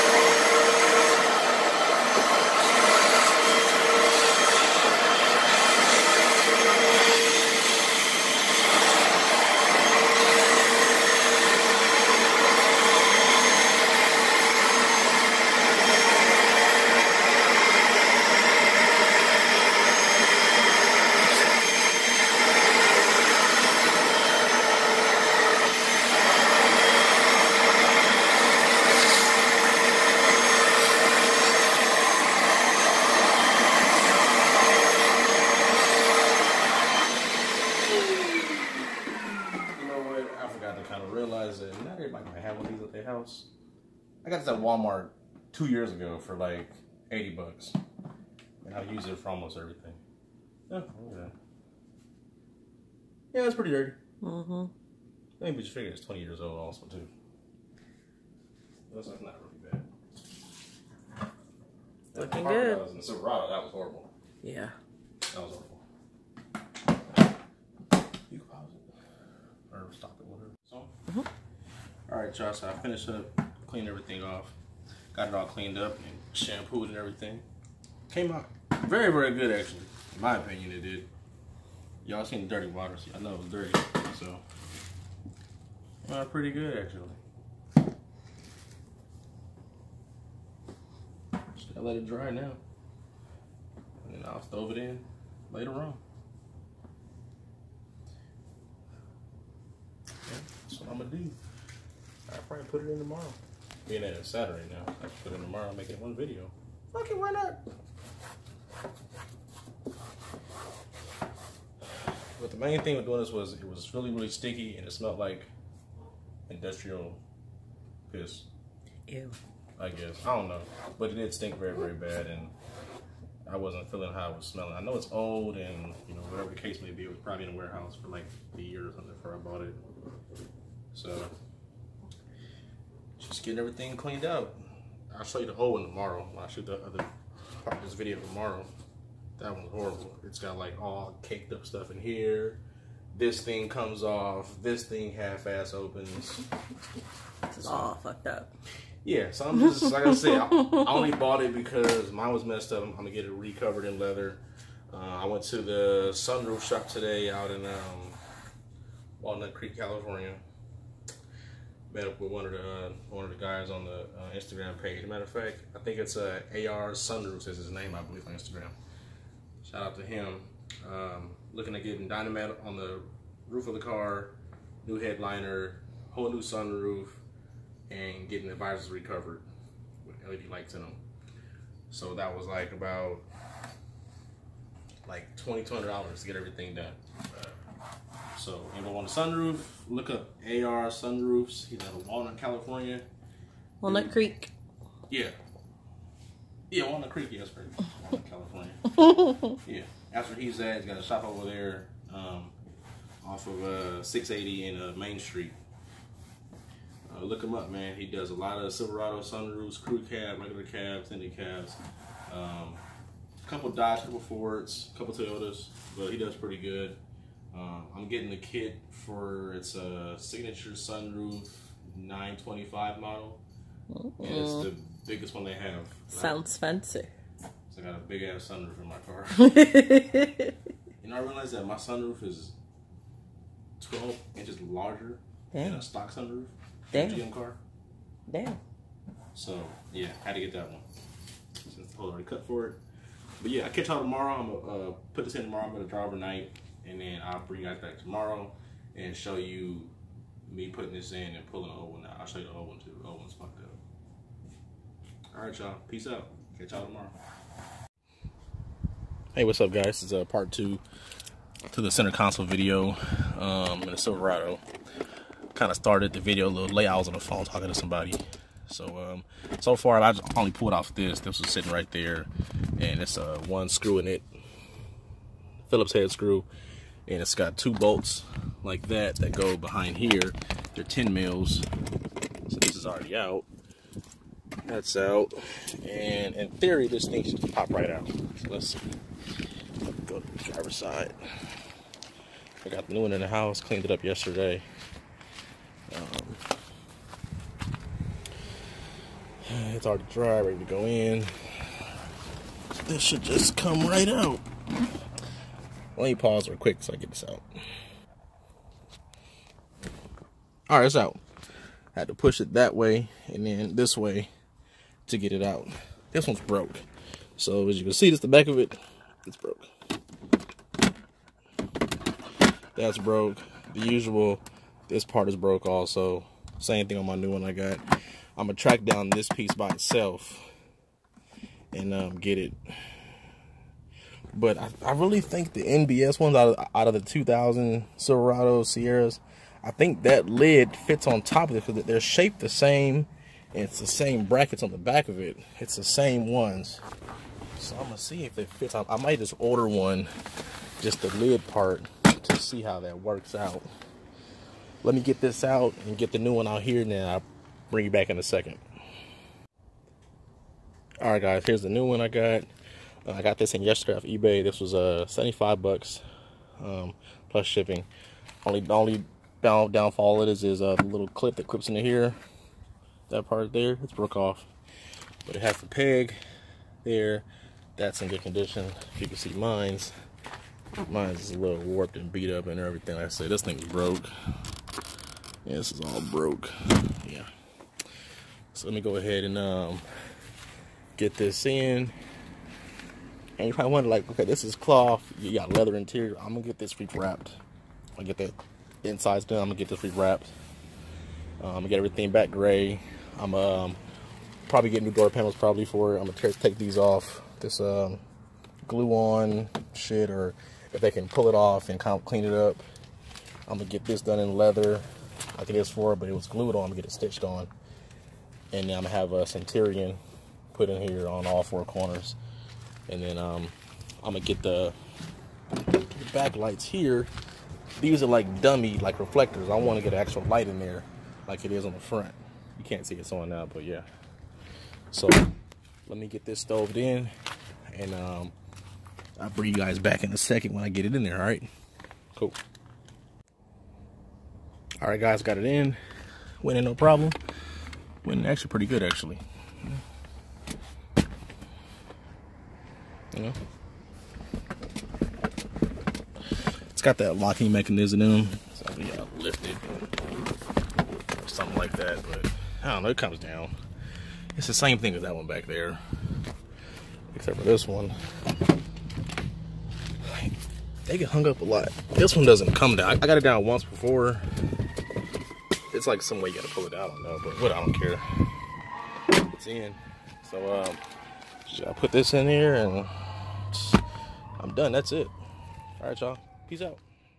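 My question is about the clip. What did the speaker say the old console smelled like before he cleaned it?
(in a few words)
industrial piss.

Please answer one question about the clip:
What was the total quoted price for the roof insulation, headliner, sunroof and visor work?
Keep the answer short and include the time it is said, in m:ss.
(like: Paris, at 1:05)
$2,200, at 3:05.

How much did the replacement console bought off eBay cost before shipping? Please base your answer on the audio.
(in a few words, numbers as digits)
75 bucks.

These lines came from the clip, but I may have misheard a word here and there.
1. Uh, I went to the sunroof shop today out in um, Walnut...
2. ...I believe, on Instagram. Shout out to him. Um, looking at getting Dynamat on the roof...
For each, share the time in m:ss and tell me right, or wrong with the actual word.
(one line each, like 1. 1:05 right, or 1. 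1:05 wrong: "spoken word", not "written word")
1. 2:34 right
2. 2:47 right.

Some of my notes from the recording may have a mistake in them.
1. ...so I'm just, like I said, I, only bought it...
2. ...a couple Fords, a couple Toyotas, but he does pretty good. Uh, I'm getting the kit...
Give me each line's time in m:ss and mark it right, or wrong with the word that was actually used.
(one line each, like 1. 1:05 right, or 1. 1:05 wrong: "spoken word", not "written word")
1. 2:29 right
2. 3:33 right.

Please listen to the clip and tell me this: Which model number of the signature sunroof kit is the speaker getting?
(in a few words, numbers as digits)
925.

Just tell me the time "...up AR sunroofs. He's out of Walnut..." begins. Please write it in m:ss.
3:10.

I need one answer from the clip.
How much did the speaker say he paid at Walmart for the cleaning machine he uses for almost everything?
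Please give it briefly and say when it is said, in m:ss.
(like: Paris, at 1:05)
80 bucks, at 0:47.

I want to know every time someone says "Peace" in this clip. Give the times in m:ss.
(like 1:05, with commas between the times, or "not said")
4:15, 8:06.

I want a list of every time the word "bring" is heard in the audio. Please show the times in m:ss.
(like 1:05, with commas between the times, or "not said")
4:07, 5:57, 7:19.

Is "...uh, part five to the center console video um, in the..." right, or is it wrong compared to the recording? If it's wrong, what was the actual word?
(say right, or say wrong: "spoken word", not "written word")
wrong: "two", not "five".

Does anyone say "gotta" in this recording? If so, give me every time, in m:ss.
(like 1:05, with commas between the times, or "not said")
1:31, 7:56.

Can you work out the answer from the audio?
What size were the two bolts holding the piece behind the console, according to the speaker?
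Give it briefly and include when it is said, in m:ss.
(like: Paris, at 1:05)
10 mils, at 4:40.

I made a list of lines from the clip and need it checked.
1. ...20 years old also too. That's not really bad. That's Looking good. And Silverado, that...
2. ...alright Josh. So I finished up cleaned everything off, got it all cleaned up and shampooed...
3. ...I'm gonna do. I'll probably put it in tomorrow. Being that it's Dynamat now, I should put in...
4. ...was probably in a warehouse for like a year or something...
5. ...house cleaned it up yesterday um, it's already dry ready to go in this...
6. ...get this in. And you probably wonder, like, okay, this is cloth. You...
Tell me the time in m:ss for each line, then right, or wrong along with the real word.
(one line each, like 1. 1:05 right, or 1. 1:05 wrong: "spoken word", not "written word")
1. 0:56 right
2. 1:12 right
3. 1:40 wrong: "Saturday", not "Dynamat"
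4. 2:07 right
5. 4:53 right
6. 6:30 right.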